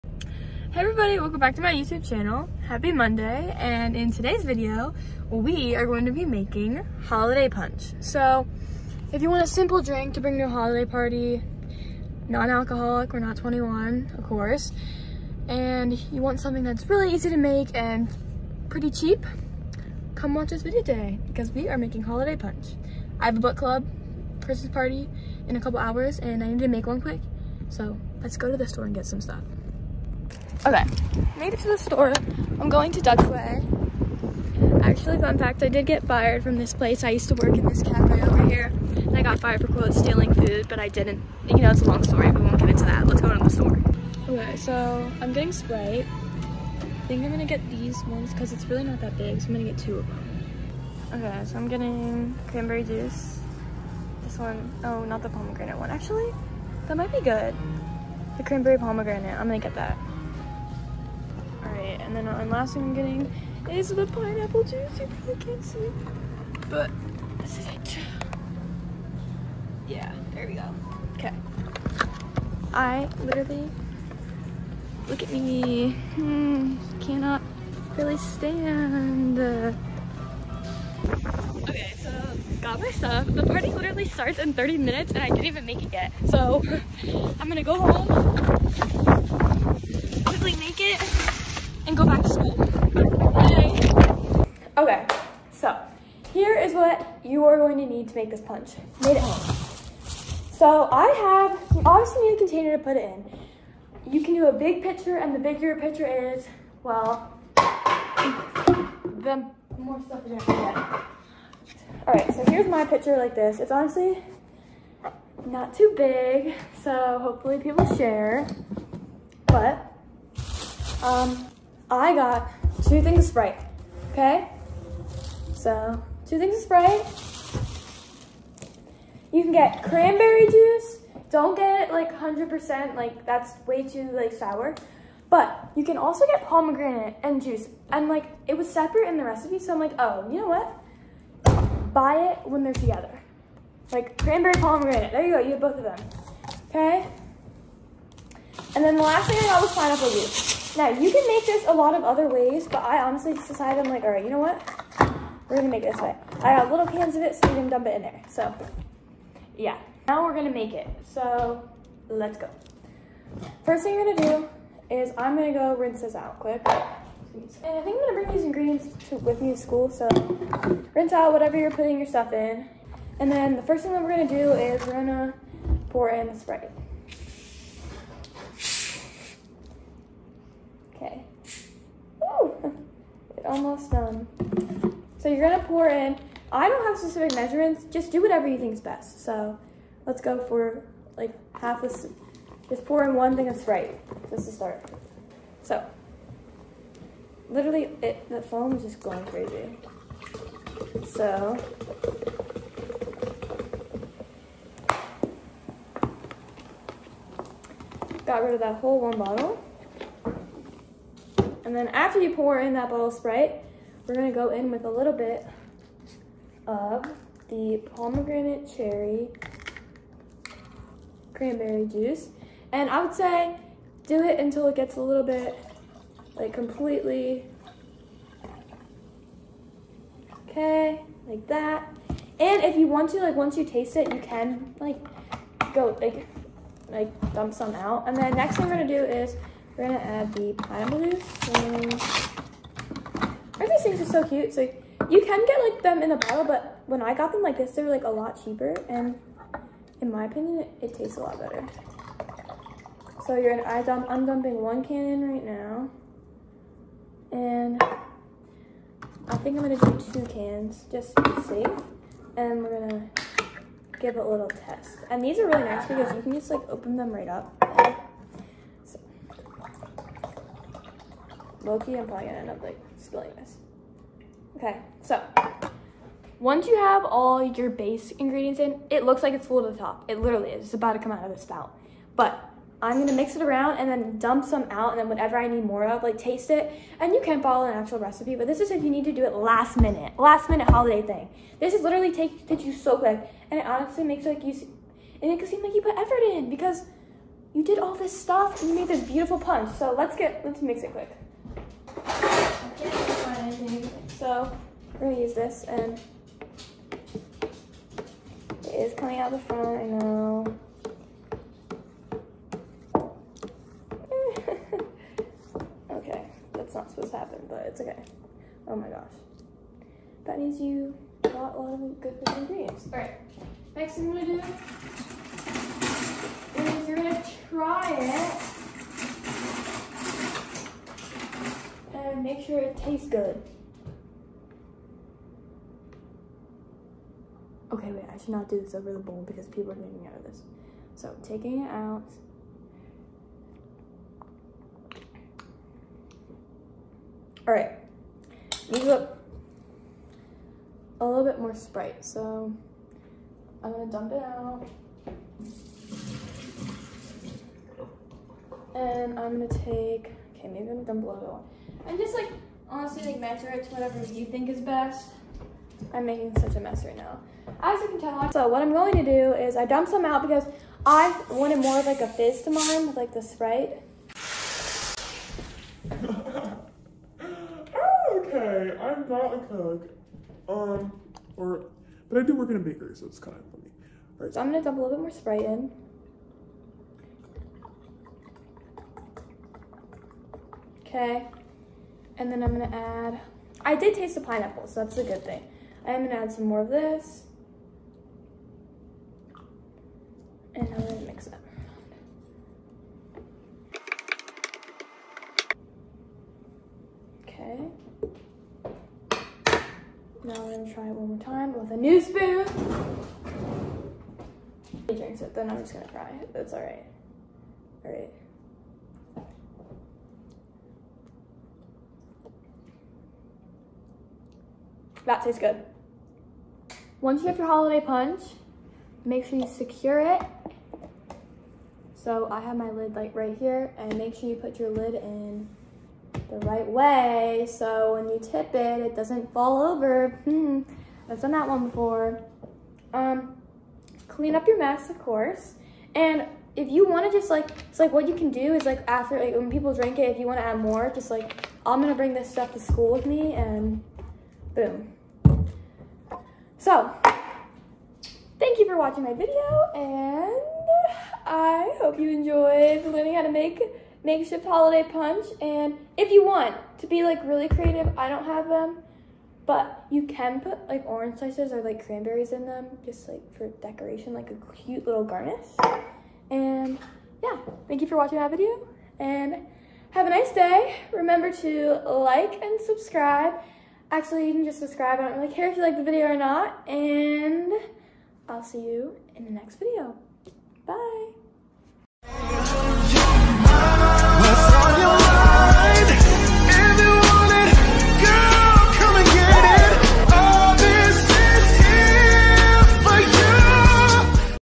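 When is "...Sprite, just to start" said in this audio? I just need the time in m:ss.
3:13.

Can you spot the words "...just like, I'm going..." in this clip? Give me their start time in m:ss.
7:30.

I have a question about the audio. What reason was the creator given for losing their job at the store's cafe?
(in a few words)
stealing food.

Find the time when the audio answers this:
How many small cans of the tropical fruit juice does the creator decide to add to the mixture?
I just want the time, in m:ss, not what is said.
4:20.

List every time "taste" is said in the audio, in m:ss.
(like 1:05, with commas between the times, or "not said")
3:53, 4:10, 4:46, 5:32, 6:33, 7:05.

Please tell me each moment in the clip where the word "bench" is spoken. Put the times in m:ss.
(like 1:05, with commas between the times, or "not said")
not said.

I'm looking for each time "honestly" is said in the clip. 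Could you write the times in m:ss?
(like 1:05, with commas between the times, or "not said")
1:53, 2:33, 4:53, 6:02.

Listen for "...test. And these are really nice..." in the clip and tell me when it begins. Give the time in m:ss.
4:24.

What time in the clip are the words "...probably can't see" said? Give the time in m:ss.
1:05.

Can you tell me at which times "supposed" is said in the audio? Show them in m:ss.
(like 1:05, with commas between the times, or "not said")
5:16.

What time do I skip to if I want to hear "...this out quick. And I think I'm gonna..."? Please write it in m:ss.
2:46.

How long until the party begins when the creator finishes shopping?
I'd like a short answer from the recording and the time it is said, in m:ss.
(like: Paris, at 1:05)
30 minutes, at 1:24.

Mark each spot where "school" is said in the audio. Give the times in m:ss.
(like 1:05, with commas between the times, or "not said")
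1:32, 2:49, 7:32.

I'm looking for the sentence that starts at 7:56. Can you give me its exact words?
And yeah, thank you for watching my video, and have a nice day.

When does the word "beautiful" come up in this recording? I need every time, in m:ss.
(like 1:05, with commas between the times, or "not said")
4:59.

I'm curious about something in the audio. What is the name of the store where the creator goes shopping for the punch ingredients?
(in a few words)
Dutch Way.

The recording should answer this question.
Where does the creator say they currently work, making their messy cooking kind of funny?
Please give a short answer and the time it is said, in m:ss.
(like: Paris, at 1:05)
a bakery, at 6:22.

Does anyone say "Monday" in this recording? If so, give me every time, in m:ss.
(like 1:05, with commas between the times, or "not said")
0:02.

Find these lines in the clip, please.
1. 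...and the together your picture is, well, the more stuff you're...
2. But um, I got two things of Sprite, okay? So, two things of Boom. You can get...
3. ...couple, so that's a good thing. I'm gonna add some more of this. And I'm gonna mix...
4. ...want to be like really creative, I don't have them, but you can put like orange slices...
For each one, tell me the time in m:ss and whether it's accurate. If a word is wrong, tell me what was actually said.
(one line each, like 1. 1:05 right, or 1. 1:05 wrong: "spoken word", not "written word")
1. 1:45 wrong: "bigger", not "together"
2. 1:59 wrong: "Sprite", not "Boom"
3. 6:34 wrong: "pineapple", not "couple"
4. 7:46 right.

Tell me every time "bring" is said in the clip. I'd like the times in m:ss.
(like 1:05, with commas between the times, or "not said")
0:10, 2:48, 7:31.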